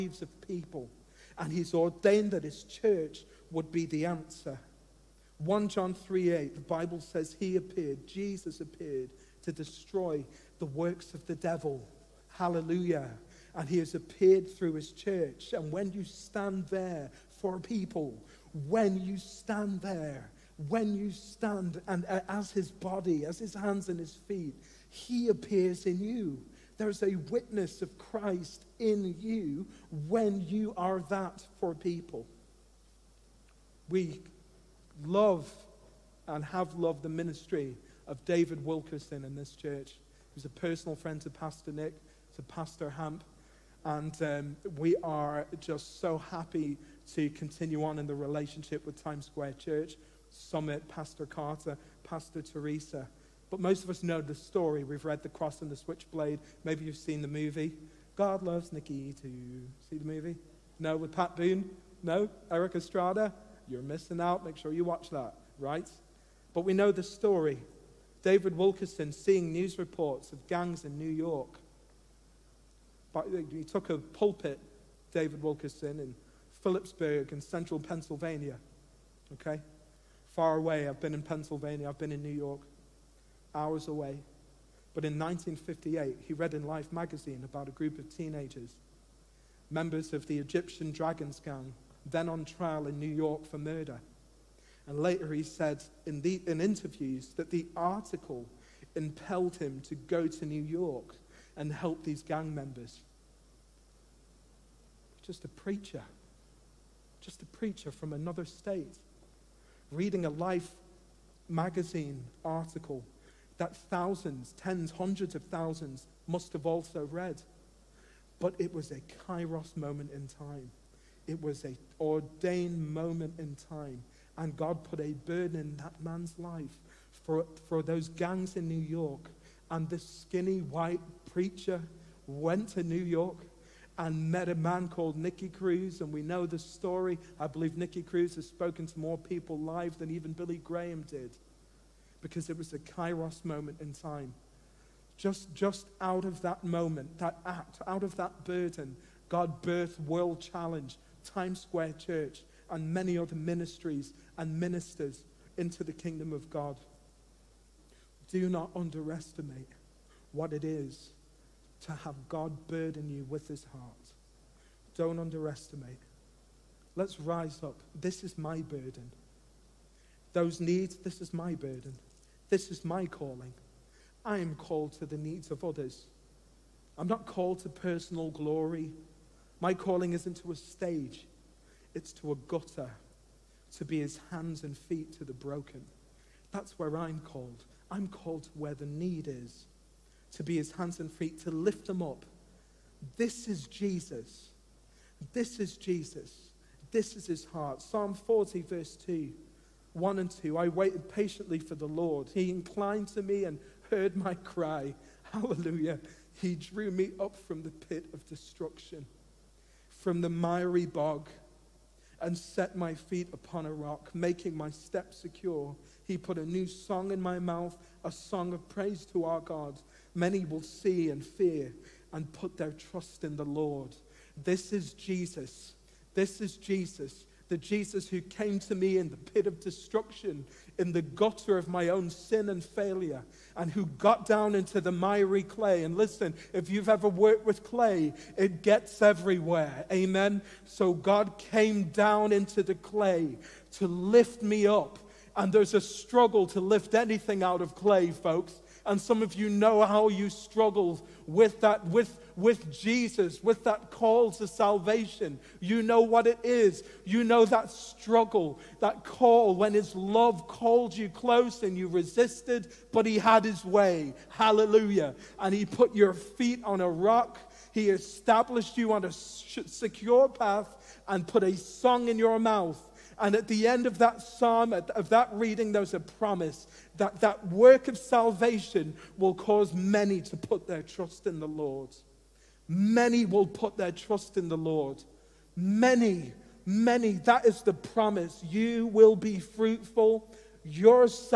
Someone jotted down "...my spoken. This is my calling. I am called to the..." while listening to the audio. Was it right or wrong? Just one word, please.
wrong.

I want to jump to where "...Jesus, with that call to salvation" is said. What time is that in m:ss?
4:12.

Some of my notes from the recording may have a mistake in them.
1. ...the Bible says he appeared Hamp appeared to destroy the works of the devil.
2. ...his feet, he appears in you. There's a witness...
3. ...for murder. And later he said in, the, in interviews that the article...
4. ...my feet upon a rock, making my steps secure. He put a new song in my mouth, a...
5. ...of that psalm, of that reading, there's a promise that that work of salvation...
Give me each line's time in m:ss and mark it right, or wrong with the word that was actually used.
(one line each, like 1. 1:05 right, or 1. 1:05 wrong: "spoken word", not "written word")
1. 0:06 wrong: "Jesus", not "Hamp"
2. 0:23 right
3. 1:33 right
4. 3:32 right
5. 4:33 right.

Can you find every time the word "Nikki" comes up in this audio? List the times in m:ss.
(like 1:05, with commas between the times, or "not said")
0:58.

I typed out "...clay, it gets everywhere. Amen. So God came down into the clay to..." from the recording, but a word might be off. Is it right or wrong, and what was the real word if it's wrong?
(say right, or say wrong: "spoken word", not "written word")
right.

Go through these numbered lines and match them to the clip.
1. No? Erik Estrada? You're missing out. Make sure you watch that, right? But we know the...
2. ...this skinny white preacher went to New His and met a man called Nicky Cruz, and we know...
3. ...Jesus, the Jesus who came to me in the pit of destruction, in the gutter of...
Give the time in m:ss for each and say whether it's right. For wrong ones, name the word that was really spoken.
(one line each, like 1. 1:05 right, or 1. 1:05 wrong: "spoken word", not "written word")
1. 1:02 right
2. 2:09 wrong: "York", not "His"
3. 3:46 right.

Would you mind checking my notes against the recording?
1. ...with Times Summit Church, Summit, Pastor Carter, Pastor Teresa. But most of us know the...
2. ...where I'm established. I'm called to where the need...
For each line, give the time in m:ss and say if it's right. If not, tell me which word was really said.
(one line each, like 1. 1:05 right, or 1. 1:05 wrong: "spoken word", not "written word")
1. 0:48 wrong: "Square", not "Summit"
2. 3:06 wrong: "called", not "established".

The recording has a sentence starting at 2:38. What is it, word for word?
Do not underestimate what it is to have God burden you with his heart.